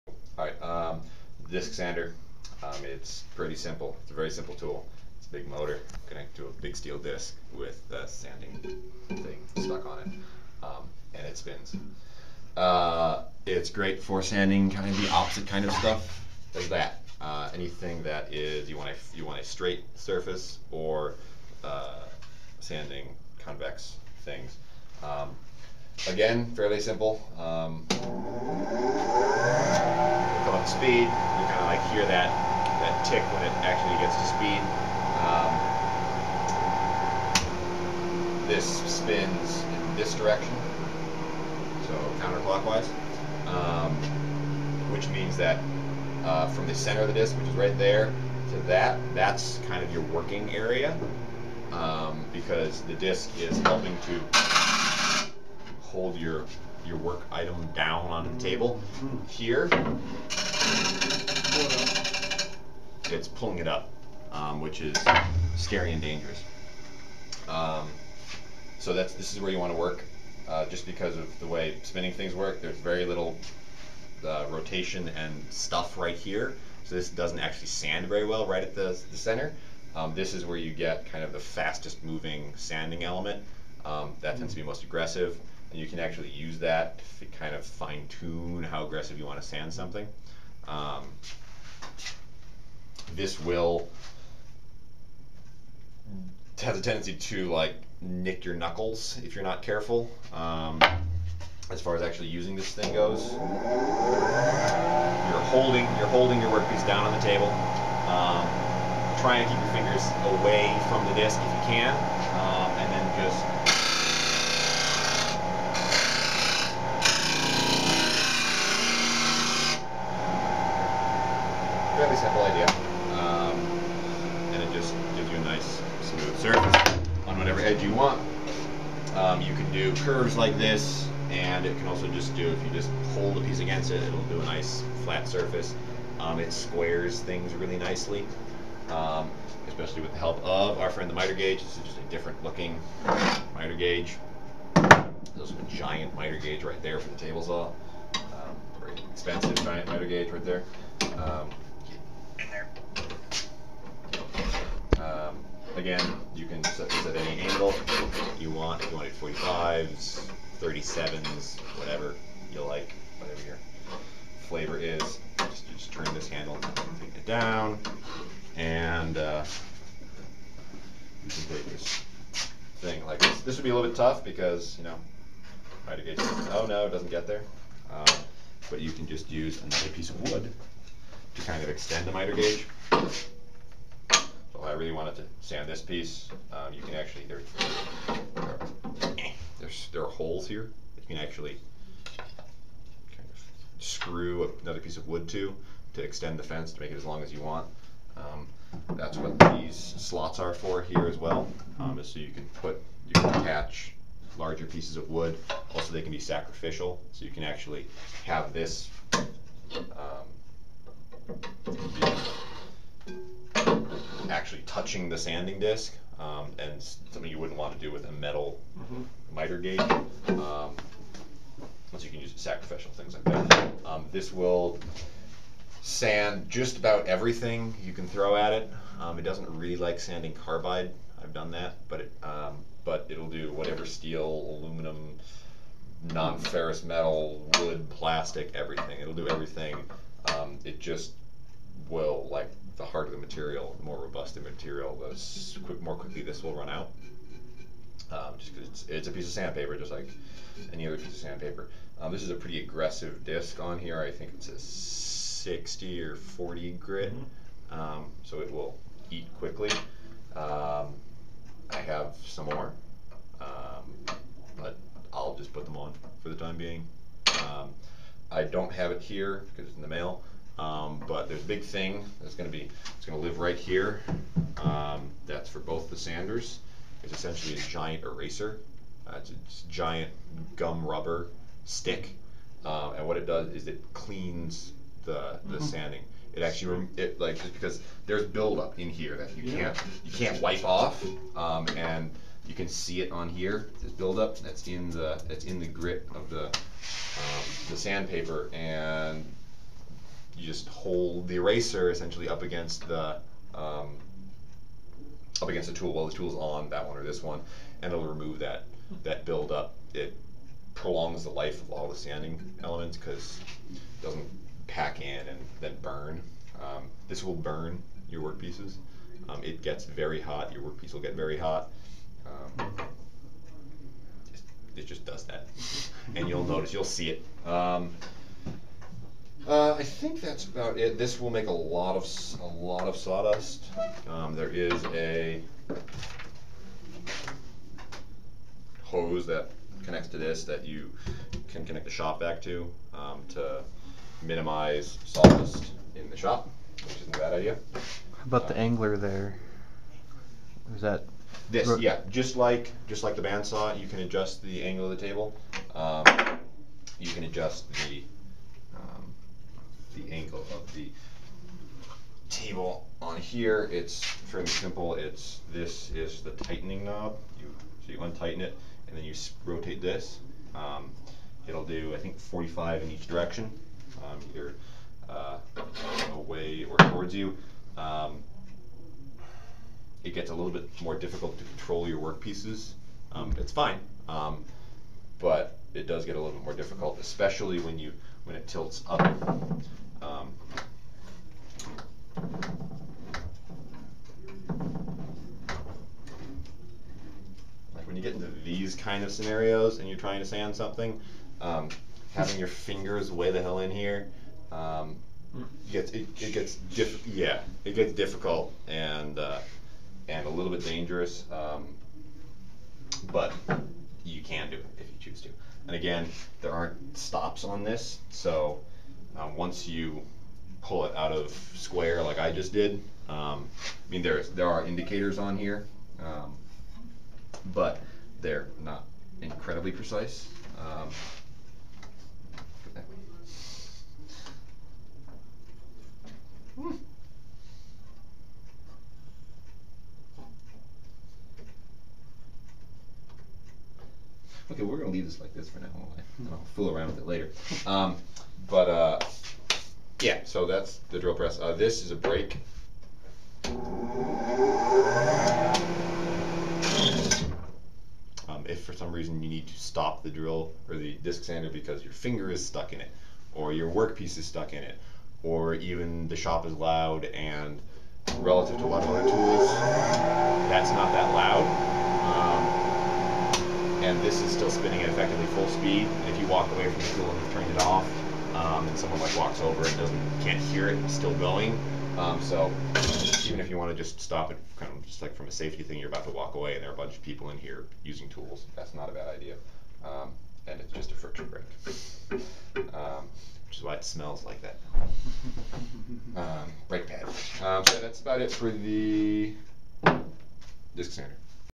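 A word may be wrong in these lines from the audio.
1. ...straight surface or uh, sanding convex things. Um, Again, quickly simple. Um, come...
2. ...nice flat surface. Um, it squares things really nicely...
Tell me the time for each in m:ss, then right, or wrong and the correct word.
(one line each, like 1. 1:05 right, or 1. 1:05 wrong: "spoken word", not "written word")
1. 0:19 wrong: "fairly", not "quickly"
2. 2:14 right.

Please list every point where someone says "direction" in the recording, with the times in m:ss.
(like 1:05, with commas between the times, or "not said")
0:40, 6:13.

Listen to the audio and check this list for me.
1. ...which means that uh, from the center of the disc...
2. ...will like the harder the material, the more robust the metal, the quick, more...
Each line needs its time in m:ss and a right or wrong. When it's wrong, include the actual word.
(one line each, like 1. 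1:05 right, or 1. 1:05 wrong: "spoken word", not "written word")
1. 0:44 right
2. 4:01 wrong: "material", not "metal".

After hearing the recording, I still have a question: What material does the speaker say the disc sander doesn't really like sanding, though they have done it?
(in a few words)
carbide.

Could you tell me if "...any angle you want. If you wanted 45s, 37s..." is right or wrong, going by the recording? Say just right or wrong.
right.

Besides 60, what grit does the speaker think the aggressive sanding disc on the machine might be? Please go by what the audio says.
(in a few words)
40.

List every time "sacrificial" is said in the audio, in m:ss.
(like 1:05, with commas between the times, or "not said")
3:26, 3:42.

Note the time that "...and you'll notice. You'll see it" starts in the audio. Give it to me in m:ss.
5:26.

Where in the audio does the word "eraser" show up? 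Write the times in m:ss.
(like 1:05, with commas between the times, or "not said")
4:38, 5:01.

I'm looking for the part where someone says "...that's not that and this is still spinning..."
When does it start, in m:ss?
7:50.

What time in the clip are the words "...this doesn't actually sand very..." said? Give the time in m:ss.
1:16.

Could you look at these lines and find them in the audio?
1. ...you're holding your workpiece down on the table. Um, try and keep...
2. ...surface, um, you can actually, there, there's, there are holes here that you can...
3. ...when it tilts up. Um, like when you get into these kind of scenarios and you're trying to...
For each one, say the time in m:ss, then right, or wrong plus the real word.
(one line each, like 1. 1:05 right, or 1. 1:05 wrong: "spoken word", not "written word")
1. 1:45 right
2. 3:05 wrong: "piece", not "surface"
3. 6:28 right.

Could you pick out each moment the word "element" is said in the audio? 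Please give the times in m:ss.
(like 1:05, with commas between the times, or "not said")
1:23, 5:12.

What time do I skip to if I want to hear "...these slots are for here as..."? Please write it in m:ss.
3:19.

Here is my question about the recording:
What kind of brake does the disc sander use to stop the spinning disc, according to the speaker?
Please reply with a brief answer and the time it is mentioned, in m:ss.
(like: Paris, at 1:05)
friction brake, at 8:10.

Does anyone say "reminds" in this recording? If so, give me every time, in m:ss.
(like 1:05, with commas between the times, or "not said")
not said.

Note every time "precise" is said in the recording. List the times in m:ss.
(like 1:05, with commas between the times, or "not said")
7:09.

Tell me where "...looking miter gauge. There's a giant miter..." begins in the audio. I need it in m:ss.
2:22.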